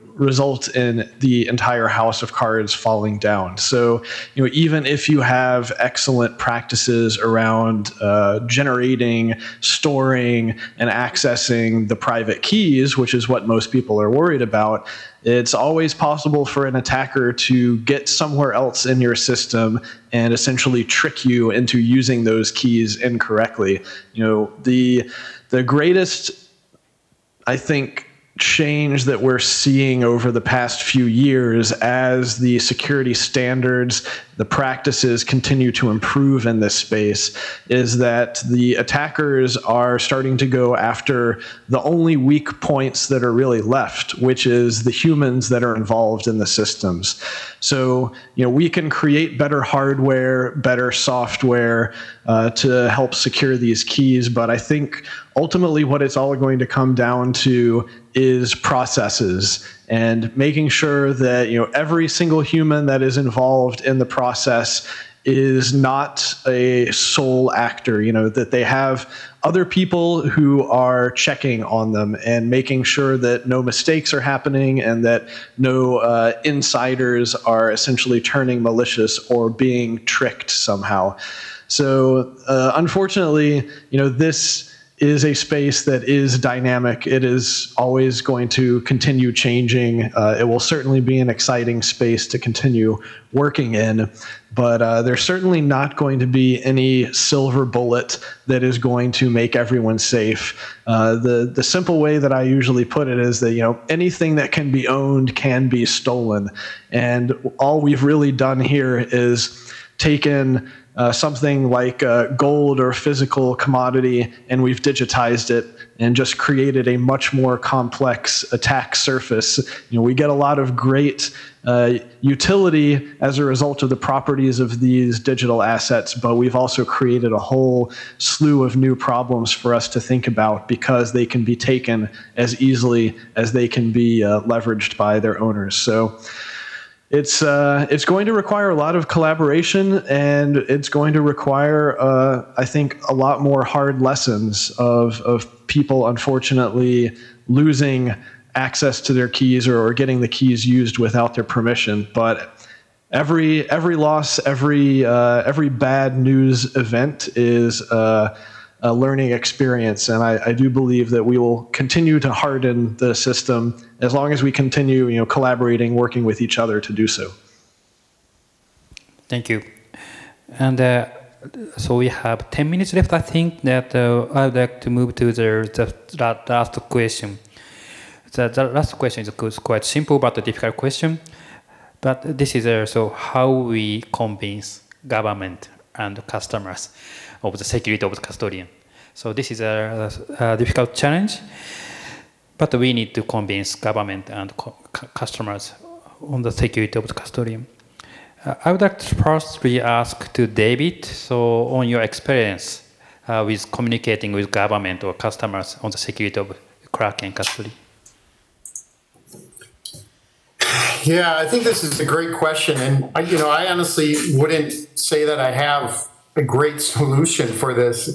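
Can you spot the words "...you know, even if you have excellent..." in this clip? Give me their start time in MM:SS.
00:04.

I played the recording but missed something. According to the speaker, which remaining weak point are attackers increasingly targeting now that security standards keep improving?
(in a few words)
The humans.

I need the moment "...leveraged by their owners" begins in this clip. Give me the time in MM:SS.
02:14.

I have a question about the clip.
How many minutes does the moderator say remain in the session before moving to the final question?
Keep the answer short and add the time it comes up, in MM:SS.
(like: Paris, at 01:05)
10, at 02:52.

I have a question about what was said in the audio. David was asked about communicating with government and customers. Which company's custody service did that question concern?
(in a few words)
Kraken.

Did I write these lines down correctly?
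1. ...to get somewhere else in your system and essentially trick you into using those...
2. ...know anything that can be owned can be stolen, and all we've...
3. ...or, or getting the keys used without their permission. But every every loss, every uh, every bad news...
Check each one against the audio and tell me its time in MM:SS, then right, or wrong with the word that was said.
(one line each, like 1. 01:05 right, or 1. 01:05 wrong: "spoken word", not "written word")
1. 00:17 right
2. 01:43 right
3. 02:29 right.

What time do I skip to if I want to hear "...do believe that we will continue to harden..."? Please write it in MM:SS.
02:40.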